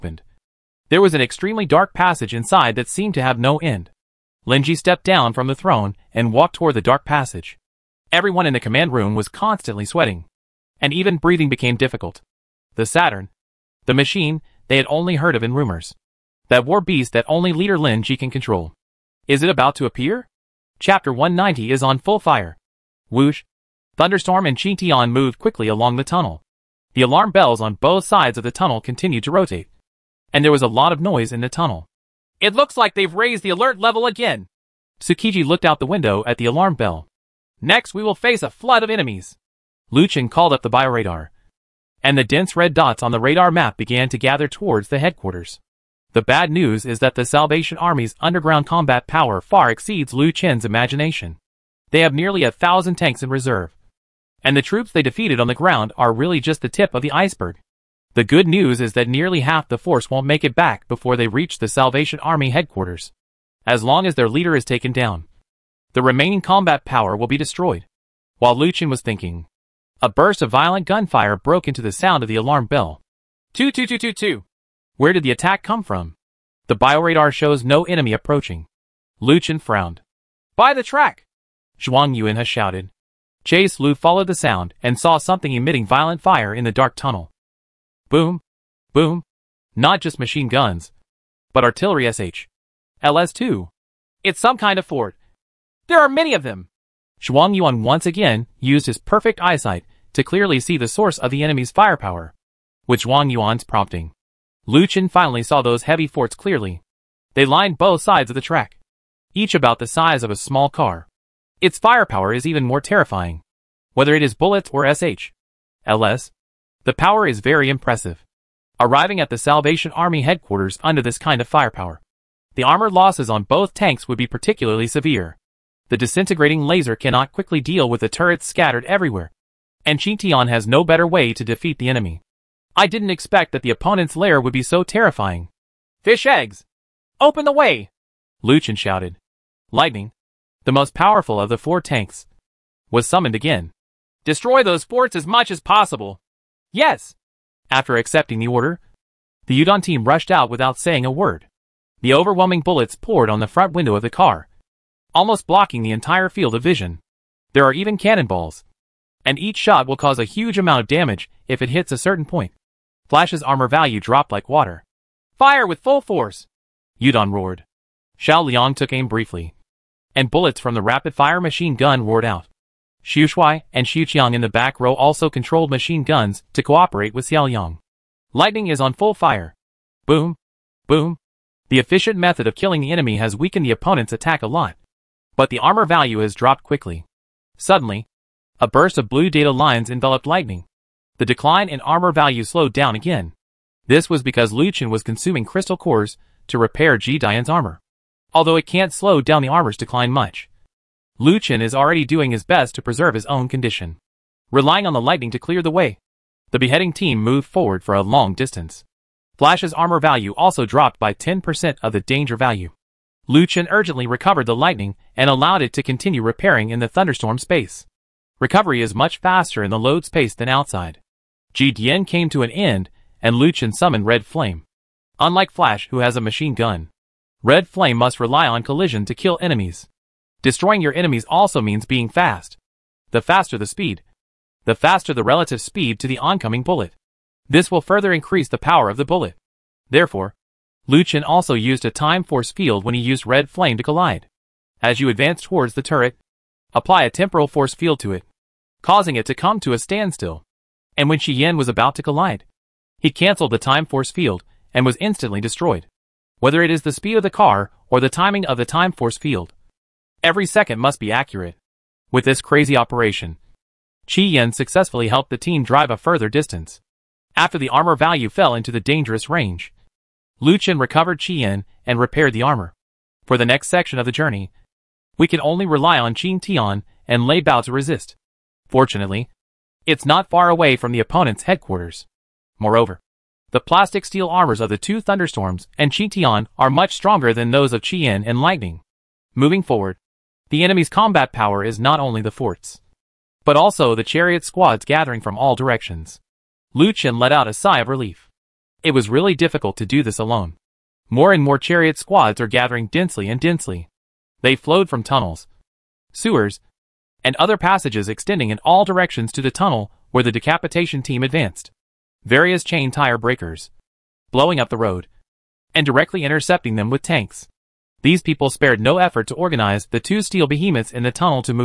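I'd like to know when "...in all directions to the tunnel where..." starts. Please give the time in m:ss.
5:08.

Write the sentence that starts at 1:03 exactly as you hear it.
As long as their leader is taken down, the remaining combat power will be destroyed.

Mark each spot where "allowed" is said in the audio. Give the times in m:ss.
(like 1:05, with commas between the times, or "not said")
3:35.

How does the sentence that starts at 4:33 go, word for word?
For the next section of the journey, we can only rely on Qingtian and Lei Bao to resist.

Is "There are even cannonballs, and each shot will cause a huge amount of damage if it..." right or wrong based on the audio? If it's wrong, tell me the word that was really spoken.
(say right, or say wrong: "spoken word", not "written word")
right.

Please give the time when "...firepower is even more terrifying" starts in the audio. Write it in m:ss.
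1:51.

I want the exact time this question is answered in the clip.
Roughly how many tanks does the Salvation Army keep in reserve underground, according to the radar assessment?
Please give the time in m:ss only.
0:52.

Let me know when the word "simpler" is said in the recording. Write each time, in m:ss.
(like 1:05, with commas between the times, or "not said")
not said.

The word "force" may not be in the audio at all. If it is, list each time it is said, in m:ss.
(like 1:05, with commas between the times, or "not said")
0:59, 2:46, 4:02, 4:07, 4:13, 4:18.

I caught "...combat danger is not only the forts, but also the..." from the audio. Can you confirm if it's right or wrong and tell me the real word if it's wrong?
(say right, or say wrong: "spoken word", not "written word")
wrong: "power", not "danger".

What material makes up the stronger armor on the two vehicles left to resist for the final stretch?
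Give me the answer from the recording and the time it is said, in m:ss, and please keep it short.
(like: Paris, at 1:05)
plastic steel, at 4:43.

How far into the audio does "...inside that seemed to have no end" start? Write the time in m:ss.
0:02.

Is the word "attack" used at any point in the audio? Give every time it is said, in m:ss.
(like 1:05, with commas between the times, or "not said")
1:15, 3:04.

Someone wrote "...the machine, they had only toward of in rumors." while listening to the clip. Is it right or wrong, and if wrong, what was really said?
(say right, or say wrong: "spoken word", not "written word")
wrong: "heard", not "toward".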